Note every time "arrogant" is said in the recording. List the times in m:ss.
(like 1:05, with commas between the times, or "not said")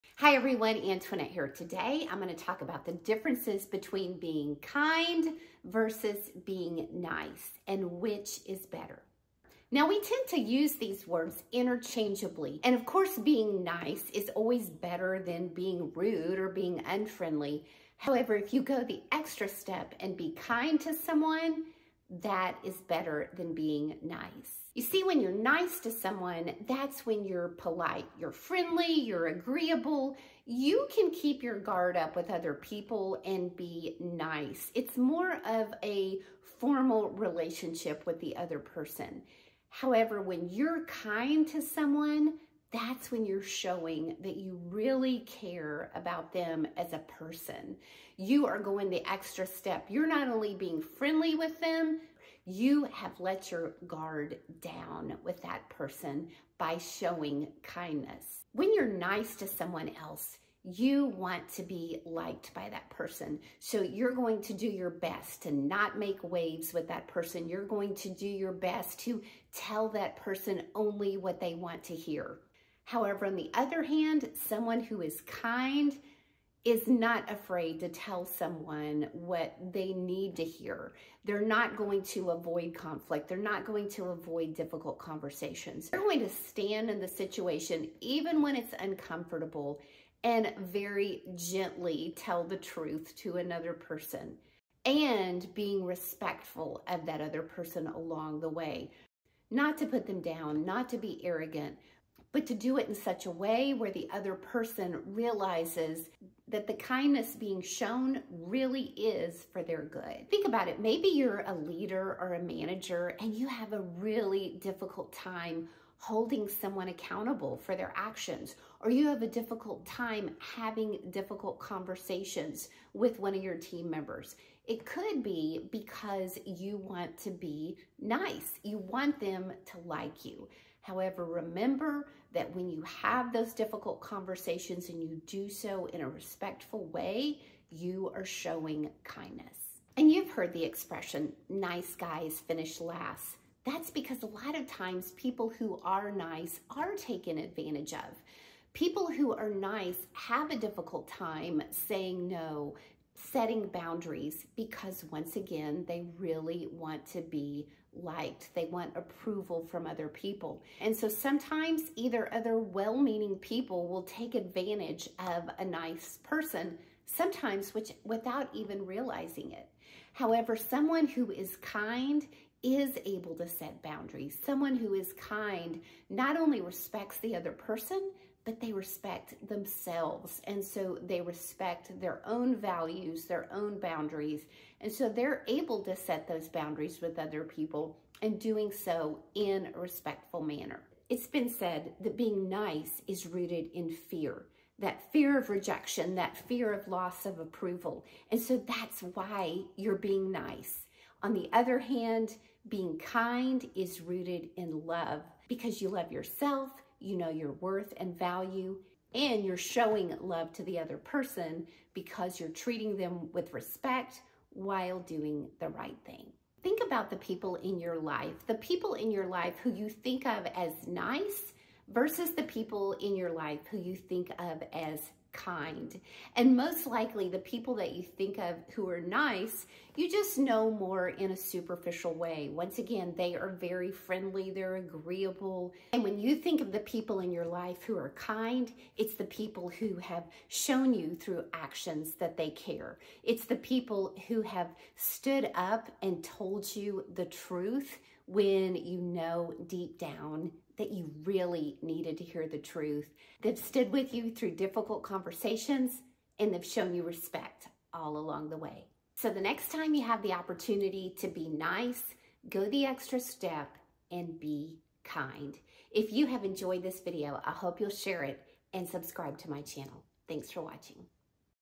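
1:41.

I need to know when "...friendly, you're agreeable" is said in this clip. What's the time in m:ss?
0:28.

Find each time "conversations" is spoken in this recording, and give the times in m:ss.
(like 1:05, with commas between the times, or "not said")
1:24, 2:01, 2:14, 4:15.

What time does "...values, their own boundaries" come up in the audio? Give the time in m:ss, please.
3:02.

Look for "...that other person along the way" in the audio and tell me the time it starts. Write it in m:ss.
1:37.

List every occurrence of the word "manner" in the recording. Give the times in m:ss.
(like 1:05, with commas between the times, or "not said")
3:10.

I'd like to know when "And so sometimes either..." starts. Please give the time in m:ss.
2:40.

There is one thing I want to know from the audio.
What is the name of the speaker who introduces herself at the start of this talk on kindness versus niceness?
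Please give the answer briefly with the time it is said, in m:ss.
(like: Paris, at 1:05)
Antoinette, at 0:00.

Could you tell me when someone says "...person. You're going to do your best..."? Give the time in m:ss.
1:07.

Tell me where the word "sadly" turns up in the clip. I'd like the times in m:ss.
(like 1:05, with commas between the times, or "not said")
not said.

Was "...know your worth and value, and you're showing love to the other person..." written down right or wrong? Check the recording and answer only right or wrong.
right.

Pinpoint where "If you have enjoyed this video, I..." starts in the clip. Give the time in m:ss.
4:25.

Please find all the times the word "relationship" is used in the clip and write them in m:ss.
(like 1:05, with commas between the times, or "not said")
0:37.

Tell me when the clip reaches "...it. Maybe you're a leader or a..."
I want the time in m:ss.
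1:50.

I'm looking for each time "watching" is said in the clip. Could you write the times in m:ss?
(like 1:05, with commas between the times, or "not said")
4:30.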